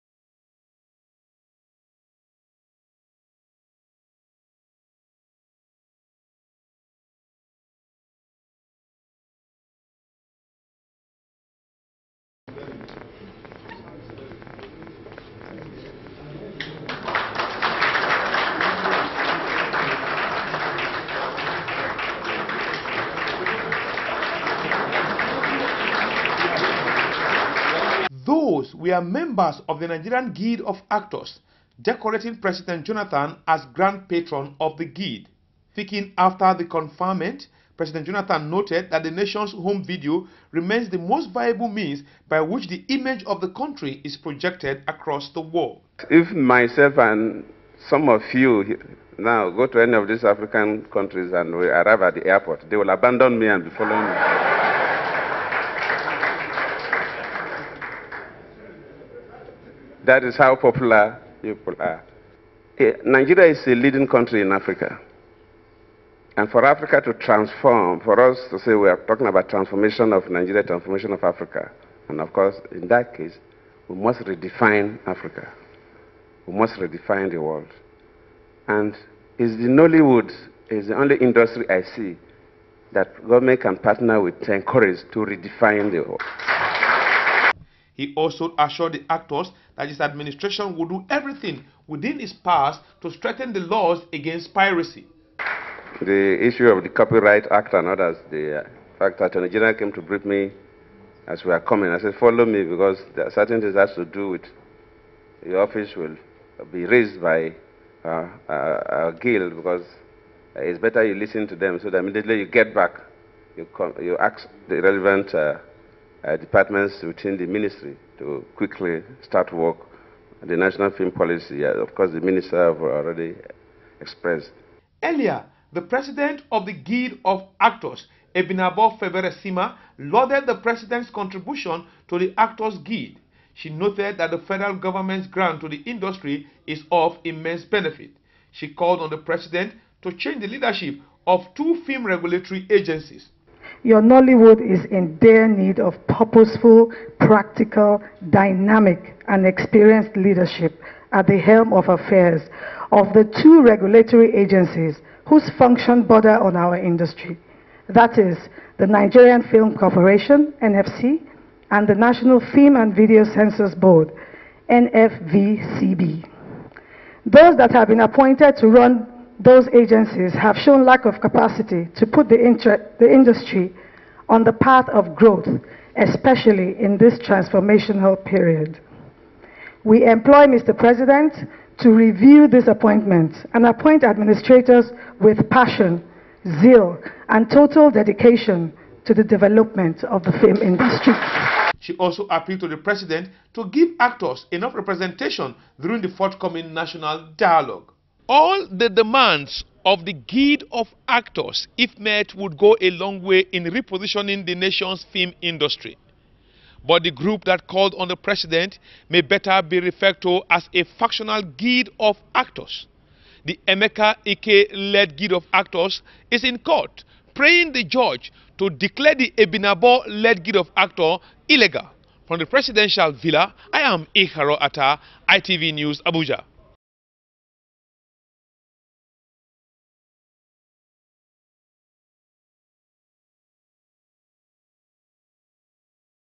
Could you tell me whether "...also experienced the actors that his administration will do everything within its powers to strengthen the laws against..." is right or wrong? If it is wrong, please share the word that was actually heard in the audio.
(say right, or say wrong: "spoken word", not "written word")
wrong: "assured", not "experienced".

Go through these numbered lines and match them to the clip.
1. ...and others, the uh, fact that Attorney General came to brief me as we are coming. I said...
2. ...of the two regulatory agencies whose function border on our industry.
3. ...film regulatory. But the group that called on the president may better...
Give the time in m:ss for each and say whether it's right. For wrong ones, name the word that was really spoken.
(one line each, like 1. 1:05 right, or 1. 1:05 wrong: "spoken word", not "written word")
1. 1:37 right
2. 2:32 right
3. 3:25 wrong: "industry", not "regulatory".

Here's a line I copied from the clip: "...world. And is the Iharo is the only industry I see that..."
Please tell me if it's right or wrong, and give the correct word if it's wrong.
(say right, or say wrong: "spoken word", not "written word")
wrong: "Nollywood", not "Iharo".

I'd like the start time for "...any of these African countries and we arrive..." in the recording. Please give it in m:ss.
0:49.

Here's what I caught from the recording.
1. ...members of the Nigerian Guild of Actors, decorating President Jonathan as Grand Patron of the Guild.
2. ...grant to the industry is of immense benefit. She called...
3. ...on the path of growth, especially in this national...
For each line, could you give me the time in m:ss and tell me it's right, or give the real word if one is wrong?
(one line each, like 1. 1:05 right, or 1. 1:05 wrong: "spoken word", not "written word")
1. 0:29 right
2. 2:15 right
3. 2:54 wrong: "transformational", not "national".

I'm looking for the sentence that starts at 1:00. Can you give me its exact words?
that is how popular people are.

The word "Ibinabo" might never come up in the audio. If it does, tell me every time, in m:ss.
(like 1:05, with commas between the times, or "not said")
2:08, 3:39.